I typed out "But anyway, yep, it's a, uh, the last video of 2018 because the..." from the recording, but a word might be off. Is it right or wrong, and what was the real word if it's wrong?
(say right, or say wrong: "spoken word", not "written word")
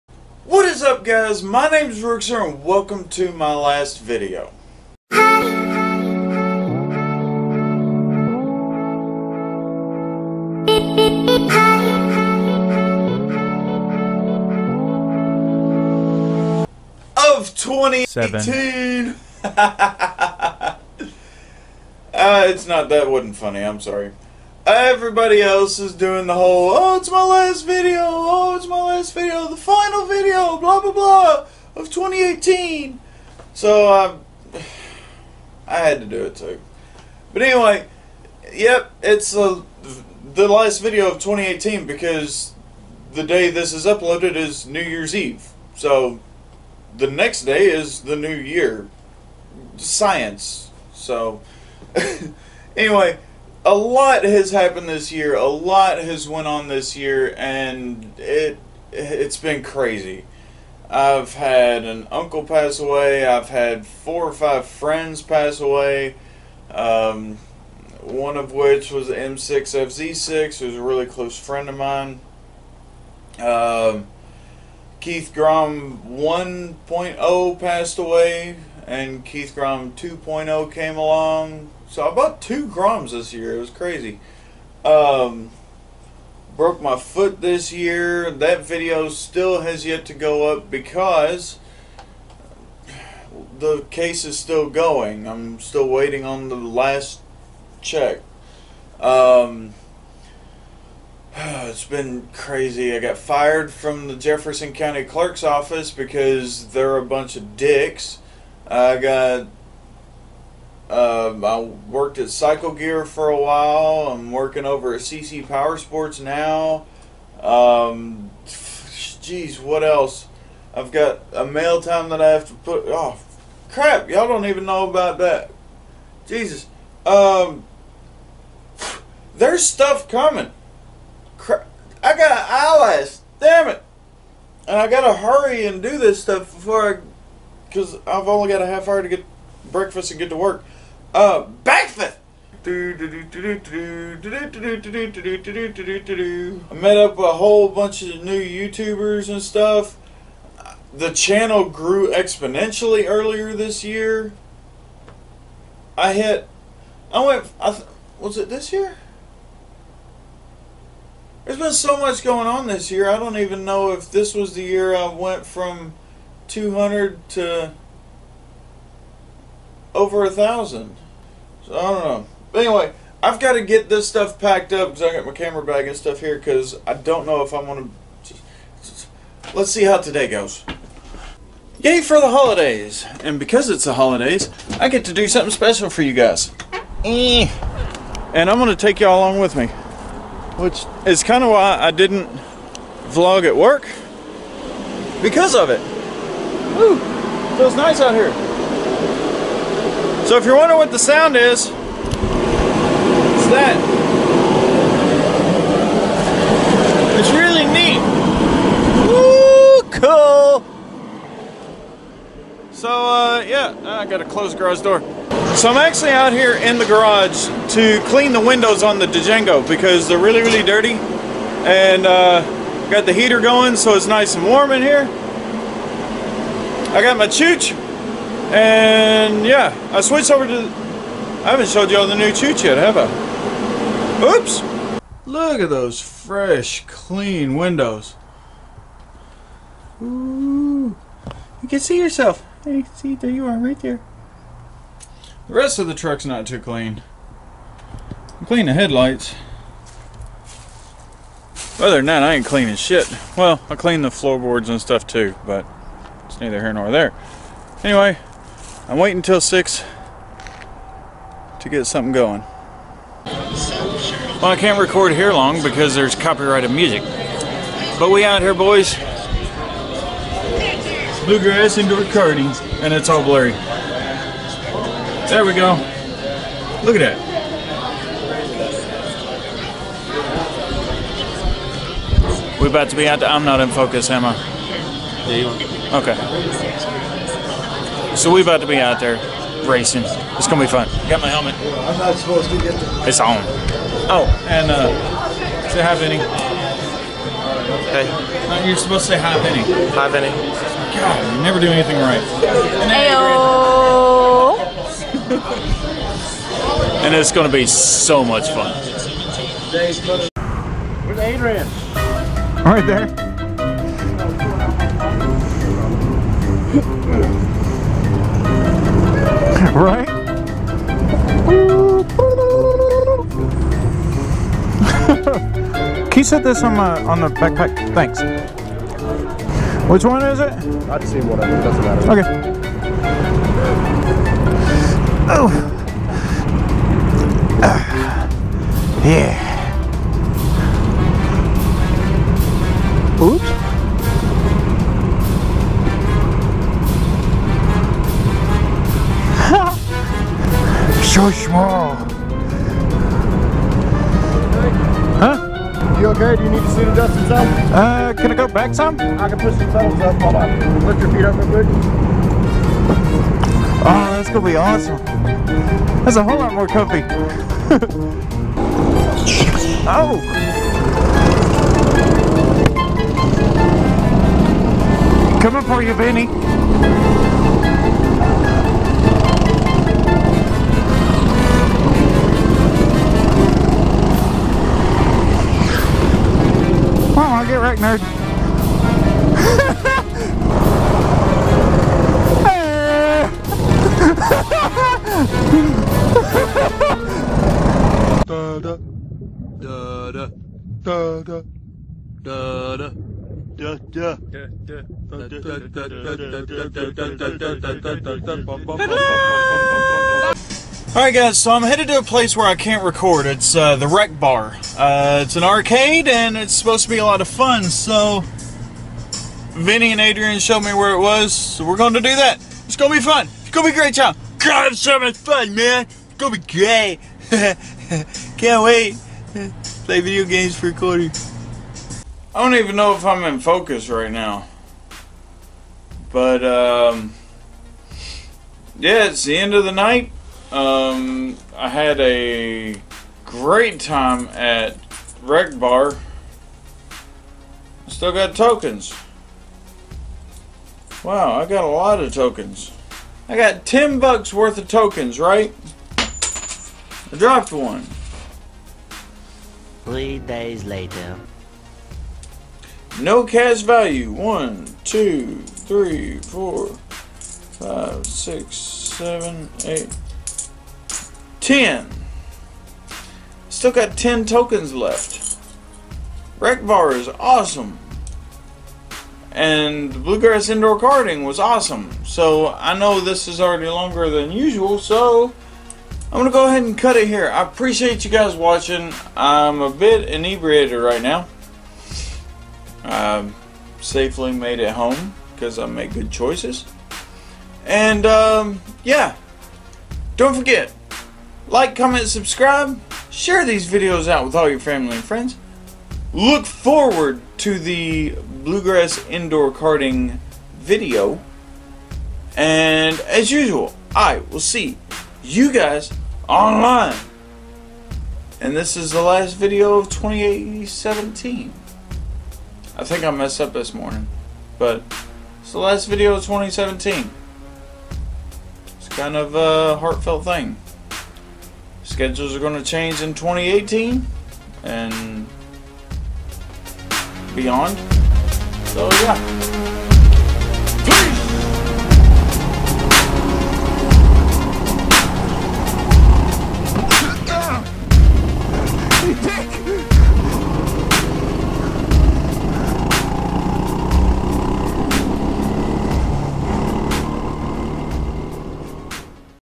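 right.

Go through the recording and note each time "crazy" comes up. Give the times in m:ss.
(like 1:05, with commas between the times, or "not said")
0:59, 1:23, 1:42.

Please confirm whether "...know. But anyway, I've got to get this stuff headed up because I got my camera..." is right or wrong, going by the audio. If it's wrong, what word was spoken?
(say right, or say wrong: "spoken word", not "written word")
wrong: "packed", not "headed".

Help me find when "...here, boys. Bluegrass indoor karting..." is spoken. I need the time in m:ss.
4:28.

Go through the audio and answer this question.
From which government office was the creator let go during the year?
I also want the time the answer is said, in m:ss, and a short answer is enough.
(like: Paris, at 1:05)
Jefferson County Clerk's office, at 1:44.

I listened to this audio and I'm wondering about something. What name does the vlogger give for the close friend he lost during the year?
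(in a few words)
M6FZ6.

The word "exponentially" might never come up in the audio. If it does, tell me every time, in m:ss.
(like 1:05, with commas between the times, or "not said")
2:32.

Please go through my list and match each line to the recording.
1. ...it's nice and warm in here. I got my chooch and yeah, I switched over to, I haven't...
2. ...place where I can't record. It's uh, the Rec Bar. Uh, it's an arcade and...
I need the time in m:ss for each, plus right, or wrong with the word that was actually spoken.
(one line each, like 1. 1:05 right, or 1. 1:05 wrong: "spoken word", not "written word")
1. 3:43 right
2. 6:52 right.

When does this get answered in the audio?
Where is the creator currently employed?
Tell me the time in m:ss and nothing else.
1:54.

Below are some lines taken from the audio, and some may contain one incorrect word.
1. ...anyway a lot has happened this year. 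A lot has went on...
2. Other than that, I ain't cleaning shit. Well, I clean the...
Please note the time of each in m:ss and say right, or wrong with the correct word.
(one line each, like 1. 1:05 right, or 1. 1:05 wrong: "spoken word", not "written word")
1. 0:52 right
2. 4:11 right.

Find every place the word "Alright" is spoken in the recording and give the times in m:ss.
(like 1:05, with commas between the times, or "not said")
6:50.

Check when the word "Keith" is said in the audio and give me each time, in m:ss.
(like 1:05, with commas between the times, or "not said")
1:14, 1:19.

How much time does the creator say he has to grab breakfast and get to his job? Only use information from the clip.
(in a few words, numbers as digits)
half hour.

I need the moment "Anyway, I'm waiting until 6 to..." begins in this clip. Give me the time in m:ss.
4:17.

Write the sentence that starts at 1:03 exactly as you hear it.
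I've had four or five friends pass away.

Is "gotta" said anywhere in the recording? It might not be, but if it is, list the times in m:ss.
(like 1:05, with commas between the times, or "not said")
2:14, 3:34.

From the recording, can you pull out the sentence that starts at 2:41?
There's been so much going on this year.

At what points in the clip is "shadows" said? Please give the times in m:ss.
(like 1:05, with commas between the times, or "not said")
not said.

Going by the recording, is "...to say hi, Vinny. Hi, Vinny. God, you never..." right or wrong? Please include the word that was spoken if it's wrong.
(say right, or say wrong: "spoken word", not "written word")
right.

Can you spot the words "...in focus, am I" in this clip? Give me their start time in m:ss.
4:43.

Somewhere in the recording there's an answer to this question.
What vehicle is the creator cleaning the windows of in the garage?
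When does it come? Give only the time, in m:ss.
3:39.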